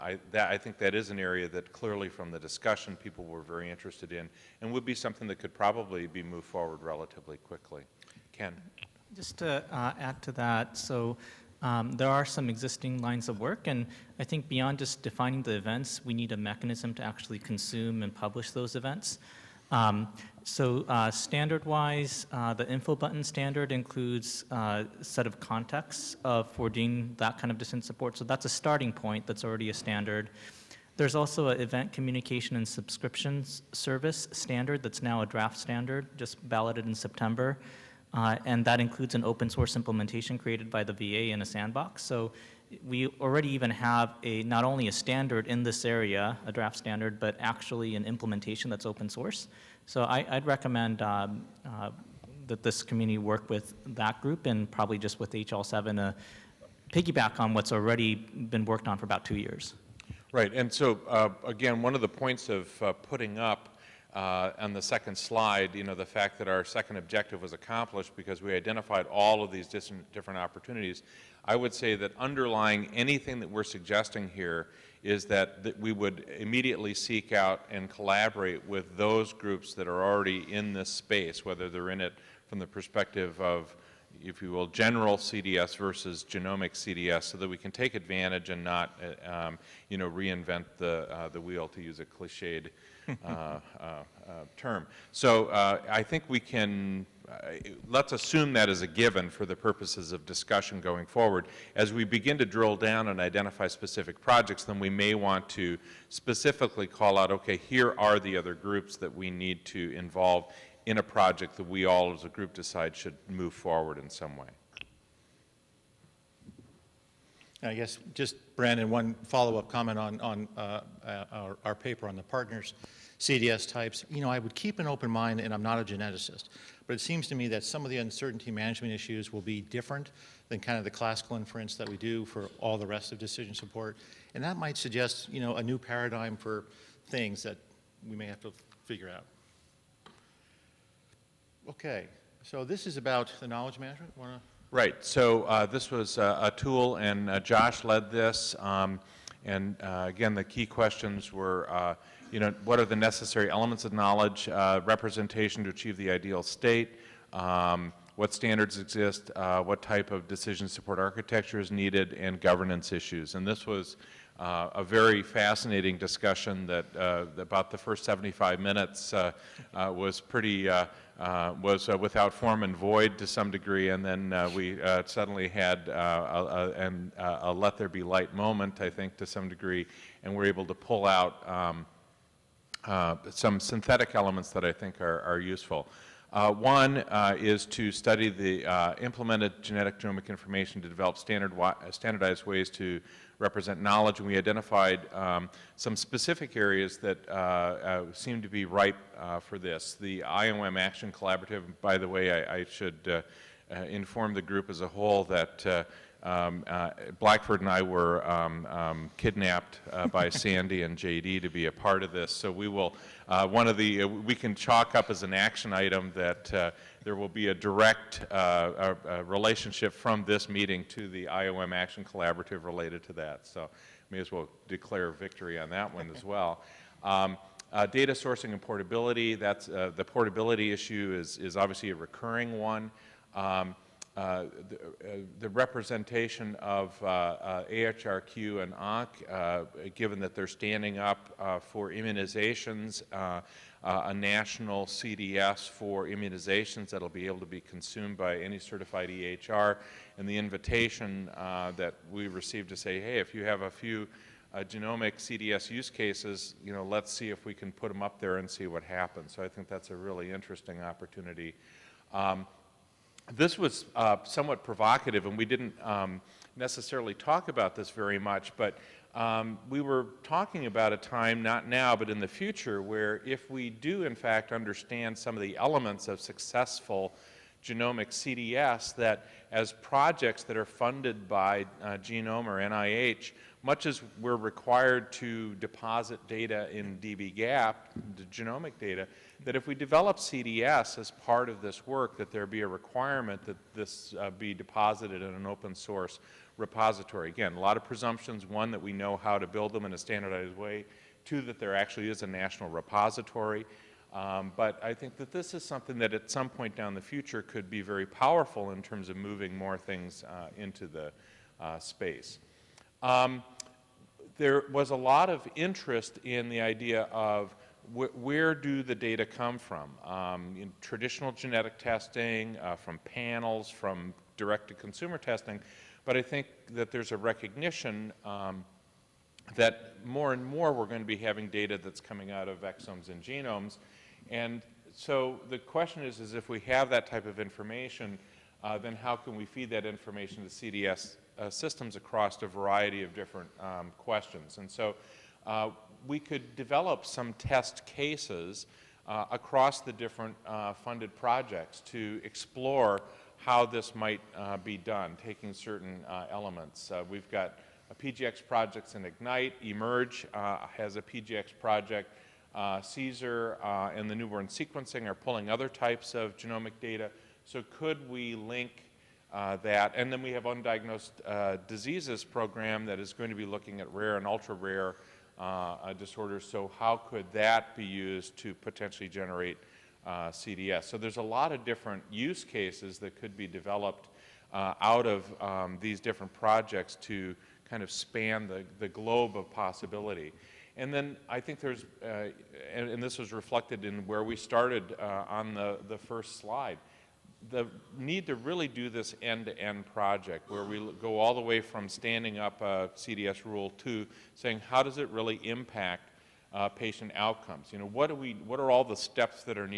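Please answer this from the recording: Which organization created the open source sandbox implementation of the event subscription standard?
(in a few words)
The VA.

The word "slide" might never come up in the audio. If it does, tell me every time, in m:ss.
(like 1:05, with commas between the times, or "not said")
1:05, 6:36.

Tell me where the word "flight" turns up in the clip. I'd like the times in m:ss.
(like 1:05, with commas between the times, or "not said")
not said.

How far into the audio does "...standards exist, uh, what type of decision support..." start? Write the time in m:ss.
2:38.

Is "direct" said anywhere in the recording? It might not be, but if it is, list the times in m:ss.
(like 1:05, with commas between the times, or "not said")
3:37, 5:24.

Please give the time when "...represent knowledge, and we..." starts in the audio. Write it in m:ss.
3:13.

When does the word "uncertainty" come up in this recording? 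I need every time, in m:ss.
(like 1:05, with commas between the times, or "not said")
2:07.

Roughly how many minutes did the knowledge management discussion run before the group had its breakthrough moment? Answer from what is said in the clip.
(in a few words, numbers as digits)
75.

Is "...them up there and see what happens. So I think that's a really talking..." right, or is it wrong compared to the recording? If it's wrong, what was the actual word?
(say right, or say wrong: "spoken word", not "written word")
wrong: "interesting", not "talking".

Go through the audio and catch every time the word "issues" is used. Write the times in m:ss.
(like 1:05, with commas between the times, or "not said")
2:08, 2:42, 3:50.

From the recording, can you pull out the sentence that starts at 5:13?
Um, there was a lot of interest in the idea of wh where do the data come from?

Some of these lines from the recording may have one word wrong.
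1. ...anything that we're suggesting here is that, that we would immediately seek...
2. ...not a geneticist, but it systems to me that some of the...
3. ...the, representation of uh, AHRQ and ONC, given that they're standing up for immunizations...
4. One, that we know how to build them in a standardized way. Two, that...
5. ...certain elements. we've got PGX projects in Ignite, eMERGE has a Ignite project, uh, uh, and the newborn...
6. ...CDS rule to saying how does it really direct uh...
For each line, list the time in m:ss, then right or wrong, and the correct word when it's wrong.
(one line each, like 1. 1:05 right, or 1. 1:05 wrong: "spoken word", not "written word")
1. 1:12 right
2. 2:05 wrong: "seems", not "systems"
3. 3:55 right
4. 4:58 right
5. 5:55 wrong: "PGX", not "Ignite"
6. 6:42 wrong: "impact", not "direct".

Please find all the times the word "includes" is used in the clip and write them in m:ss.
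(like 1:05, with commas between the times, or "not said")
0:23, 0:38.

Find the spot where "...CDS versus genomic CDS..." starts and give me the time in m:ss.
1:25.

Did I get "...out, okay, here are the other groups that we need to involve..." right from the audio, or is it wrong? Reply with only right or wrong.
right.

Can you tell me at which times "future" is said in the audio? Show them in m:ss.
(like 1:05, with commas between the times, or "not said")
4:32, 5:07.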